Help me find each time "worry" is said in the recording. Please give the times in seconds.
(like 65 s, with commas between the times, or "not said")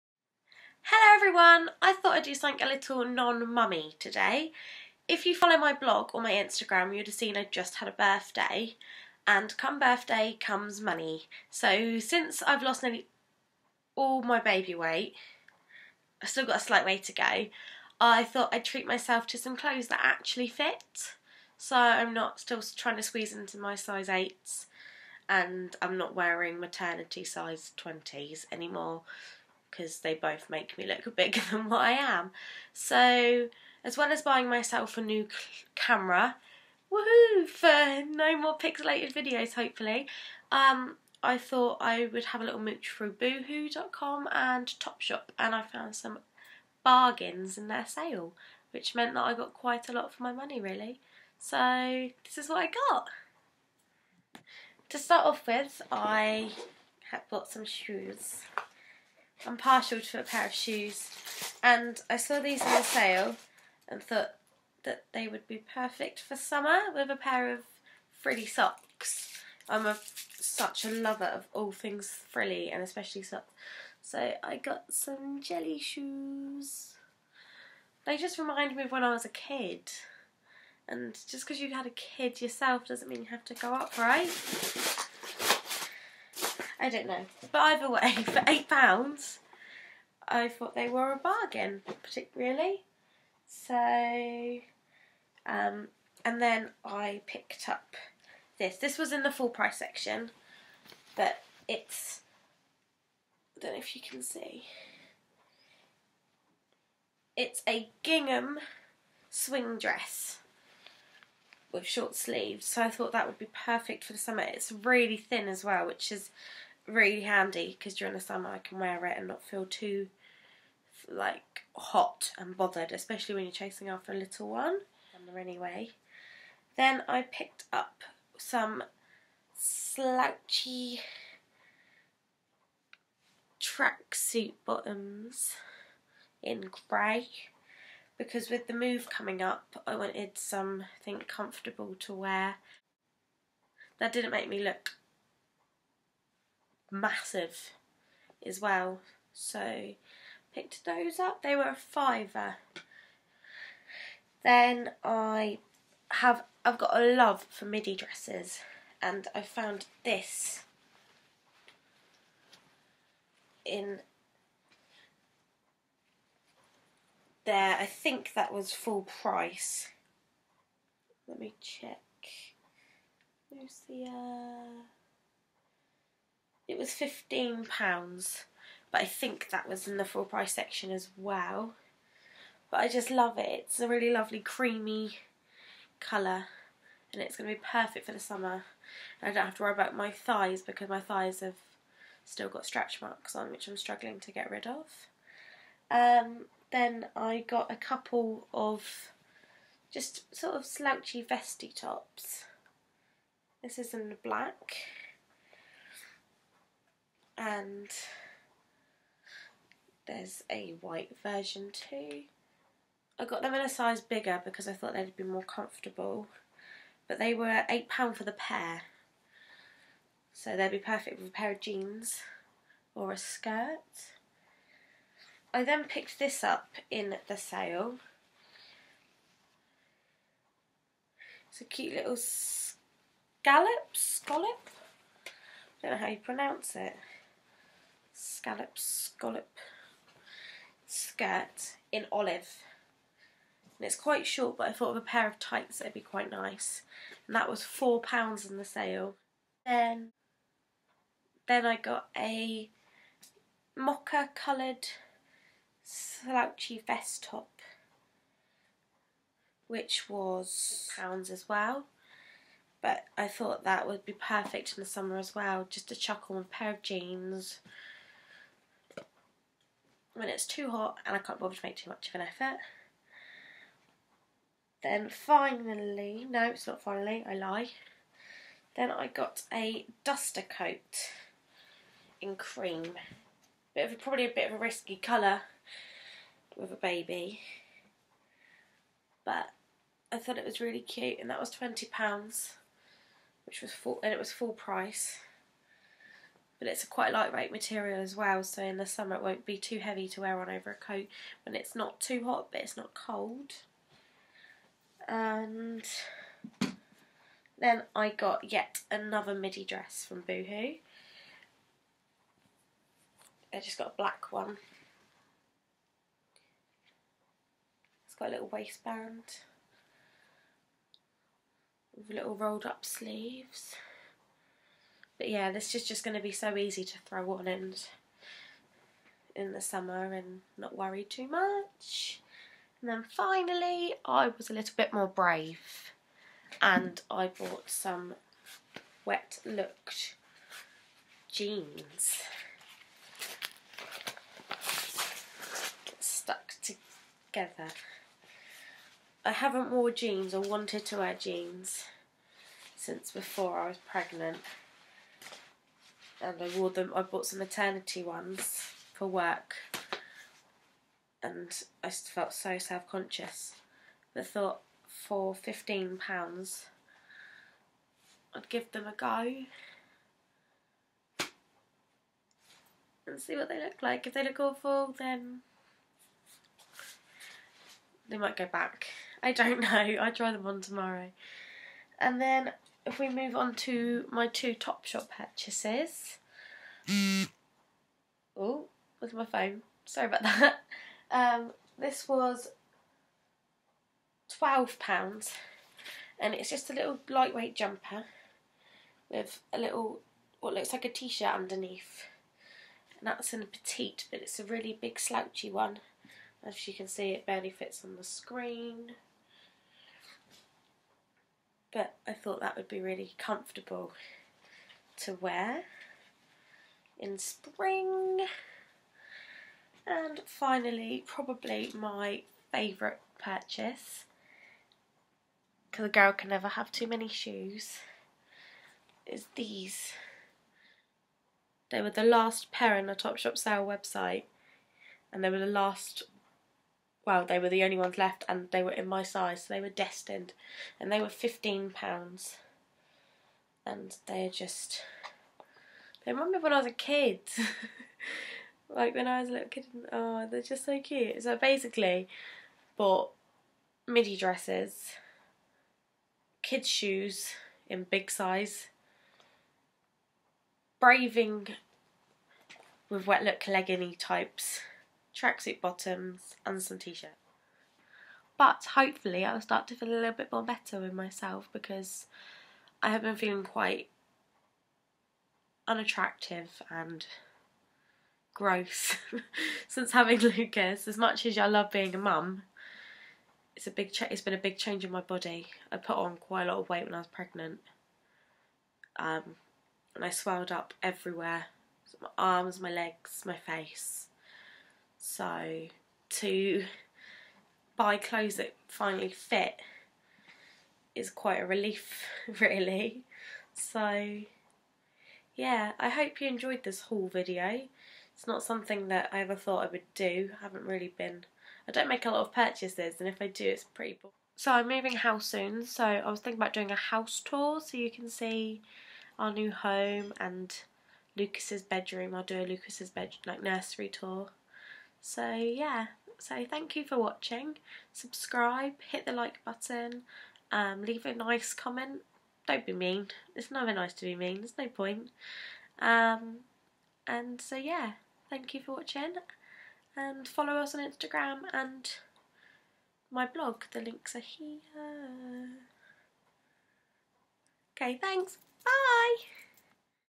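189 s, 330 s.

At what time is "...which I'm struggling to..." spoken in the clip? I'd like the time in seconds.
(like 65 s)
193 s.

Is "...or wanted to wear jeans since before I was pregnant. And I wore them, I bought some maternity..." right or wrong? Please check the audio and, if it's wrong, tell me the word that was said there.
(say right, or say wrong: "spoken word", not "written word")
right.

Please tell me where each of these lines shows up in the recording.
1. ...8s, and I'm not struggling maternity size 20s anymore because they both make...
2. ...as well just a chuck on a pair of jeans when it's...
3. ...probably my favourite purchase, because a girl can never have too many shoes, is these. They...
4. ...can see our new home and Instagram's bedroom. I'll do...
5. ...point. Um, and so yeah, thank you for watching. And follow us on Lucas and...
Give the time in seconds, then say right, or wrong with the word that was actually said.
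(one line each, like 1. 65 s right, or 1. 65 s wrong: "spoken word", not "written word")
1. 24 s wrong: "wearing", not "struggling"
2. 265 s right
3. 421 s right
4. 517 s wrong: "Lucas", not "Instagram"
5. 534 s wrong: "Instagram", not "Lucas".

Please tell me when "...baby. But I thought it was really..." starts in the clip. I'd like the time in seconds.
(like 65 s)
286 s.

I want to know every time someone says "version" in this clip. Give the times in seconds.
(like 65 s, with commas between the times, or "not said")
211 s.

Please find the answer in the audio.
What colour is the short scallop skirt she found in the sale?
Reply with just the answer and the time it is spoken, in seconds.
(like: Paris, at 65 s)
Olive, at 242 s.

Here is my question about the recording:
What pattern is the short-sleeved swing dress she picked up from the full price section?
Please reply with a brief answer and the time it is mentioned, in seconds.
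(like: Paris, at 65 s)
Gingham, at 108 s.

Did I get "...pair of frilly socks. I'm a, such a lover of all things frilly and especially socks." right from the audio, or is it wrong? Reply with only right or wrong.
right.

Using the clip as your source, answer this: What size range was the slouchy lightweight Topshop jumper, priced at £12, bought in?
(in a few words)
Petite.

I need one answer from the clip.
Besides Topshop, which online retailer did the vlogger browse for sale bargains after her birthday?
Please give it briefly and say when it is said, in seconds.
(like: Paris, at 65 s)
boohoo.com, at 43 s.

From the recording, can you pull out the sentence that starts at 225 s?
I then picked this up in the sale.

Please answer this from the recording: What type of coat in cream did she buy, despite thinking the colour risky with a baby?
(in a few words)
Duster coat.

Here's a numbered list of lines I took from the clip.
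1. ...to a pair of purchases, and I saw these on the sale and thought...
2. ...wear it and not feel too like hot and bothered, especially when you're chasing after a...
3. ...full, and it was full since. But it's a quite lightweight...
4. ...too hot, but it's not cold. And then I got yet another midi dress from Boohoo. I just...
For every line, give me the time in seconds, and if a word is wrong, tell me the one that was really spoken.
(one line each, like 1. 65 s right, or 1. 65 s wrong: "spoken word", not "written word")
1. 59 s wrong: "shoes", not "purchases"
2. 118 s right
3. 293 s wrong: "price", not "since"
4. 301 s right.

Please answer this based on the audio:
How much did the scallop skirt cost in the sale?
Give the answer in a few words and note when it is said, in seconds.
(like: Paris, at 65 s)
£4, at 247 s.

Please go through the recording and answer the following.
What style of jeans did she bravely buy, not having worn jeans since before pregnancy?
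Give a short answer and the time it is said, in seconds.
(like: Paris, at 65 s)
Wet look, at 339 s.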